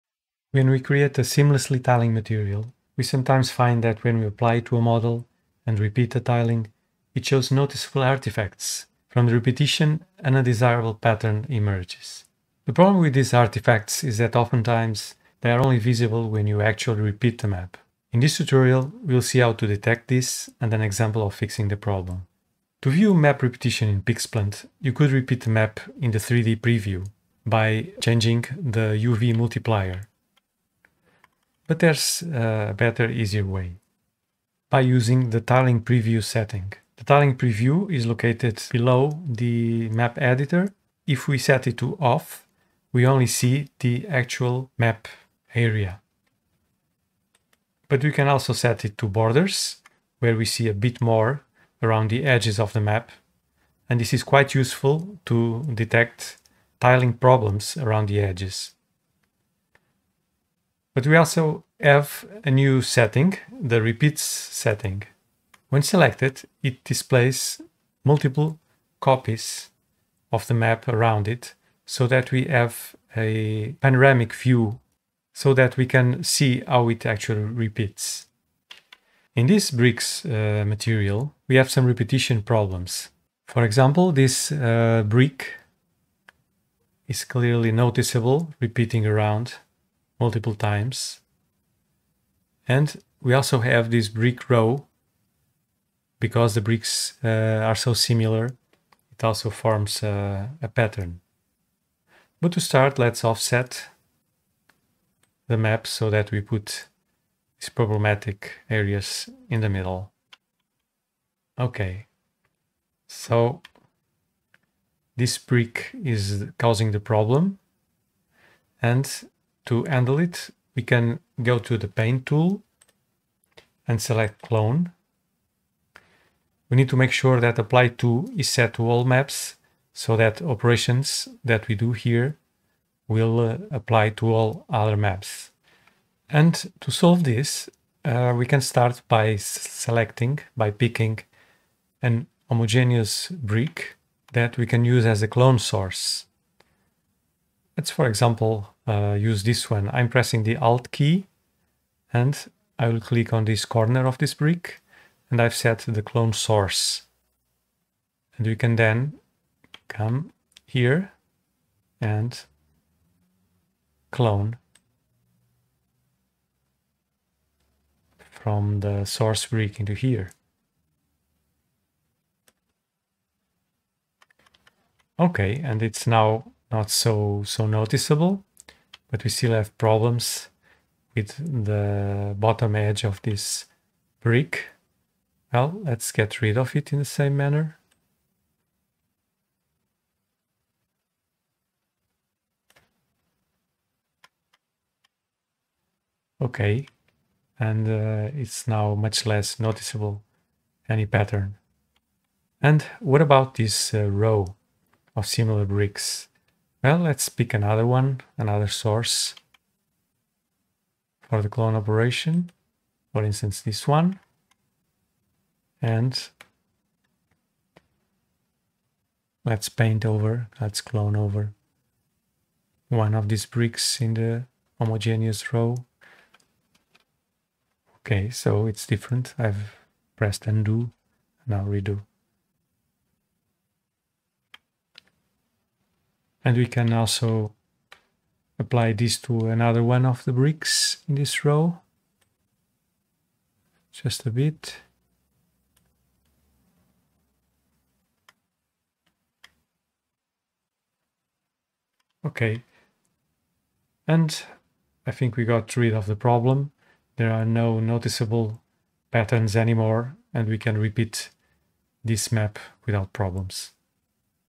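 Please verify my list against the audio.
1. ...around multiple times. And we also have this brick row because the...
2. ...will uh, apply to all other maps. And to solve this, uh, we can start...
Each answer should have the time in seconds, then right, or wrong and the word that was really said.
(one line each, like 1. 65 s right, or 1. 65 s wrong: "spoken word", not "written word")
1. 89 s right
2. 133 s right.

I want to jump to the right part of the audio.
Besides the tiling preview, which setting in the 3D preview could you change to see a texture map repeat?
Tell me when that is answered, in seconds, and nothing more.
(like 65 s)
29 s.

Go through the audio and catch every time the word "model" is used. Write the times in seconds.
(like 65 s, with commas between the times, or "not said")
4 s.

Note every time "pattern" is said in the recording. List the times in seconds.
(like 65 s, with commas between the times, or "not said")
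10 s, 100 s, 201 s, 259 s.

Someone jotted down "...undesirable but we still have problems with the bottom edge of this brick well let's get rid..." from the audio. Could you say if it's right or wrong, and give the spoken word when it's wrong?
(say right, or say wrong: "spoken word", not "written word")
wrong: "noticeable", not "undesirable".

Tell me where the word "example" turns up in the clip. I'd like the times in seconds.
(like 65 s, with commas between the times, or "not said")
20 s, 83 s, 148 s.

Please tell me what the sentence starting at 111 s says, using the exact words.
Okay, so this brick is causing the problem and to handle it, we can go to the Paint tool and select Clone.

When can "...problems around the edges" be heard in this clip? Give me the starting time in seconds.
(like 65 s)
57 s.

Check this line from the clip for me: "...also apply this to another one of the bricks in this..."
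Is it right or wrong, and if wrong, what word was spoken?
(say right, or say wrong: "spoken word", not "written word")
right.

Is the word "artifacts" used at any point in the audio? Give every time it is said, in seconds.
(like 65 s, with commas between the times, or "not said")
8 s, 13 s.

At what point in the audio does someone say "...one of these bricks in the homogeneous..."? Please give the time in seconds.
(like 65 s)
222 s.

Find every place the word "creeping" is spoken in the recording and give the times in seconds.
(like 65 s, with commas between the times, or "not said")
not said.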